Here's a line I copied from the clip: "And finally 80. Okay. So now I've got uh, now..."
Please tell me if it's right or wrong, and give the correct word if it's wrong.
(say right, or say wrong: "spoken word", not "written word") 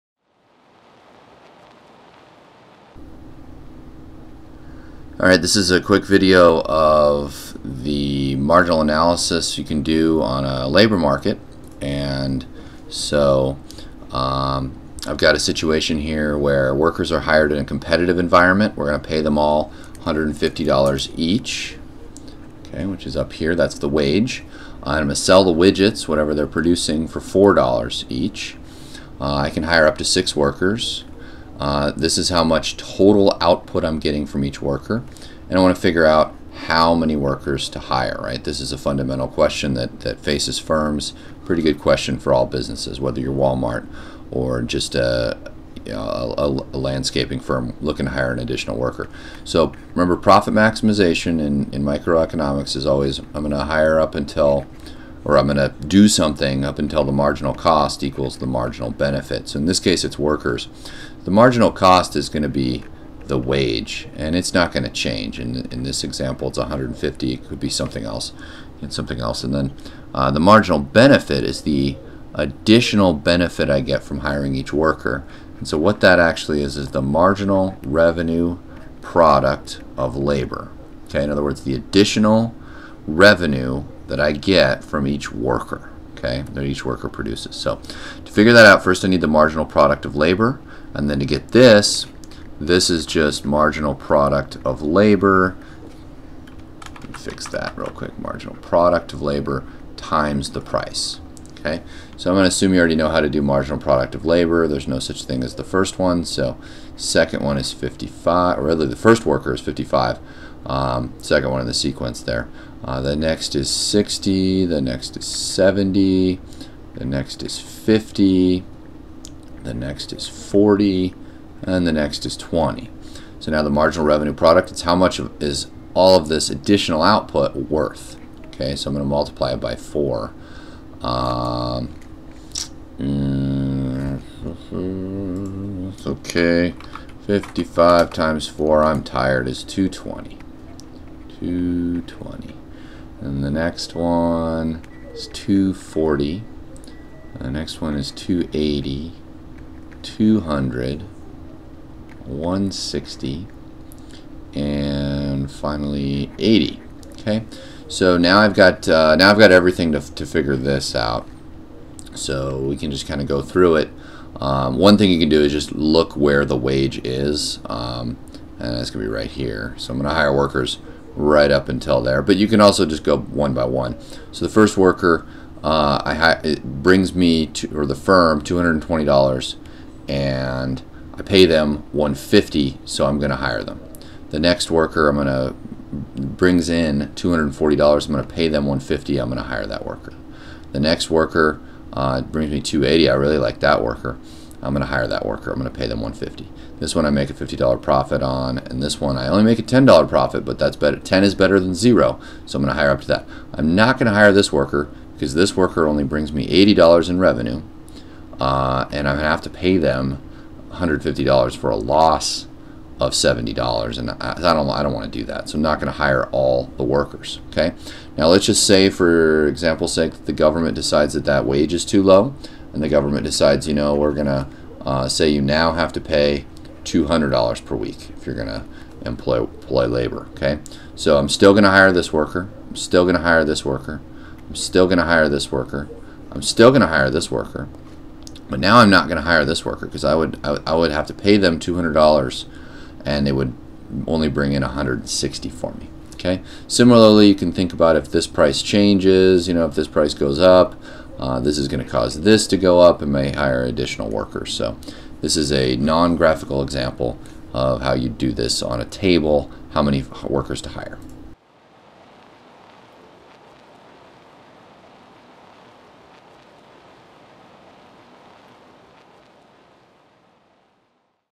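right.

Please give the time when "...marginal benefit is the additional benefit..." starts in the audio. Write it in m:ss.
1:10.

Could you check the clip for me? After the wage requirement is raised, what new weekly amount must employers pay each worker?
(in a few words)
$200.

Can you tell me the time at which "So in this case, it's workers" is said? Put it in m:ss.
0:59.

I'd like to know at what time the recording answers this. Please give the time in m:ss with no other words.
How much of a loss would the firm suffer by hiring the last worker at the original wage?
3:31.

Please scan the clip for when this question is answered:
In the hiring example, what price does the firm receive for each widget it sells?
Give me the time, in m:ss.
0:27.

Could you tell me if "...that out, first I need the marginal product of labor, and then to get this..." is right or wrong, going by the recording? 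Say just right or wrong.
right.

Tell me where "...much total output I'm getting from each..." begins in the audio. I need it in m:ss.
0:32.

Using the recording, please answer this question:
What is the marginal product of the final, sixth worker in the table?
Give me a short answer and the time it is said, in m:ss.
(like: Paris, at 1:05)
20, at 2:01.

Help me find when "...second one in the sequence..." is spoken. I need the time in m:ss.
1:51.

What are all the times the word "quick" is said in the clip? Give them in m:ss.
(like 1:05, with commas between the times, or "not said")
0:05, 1:37.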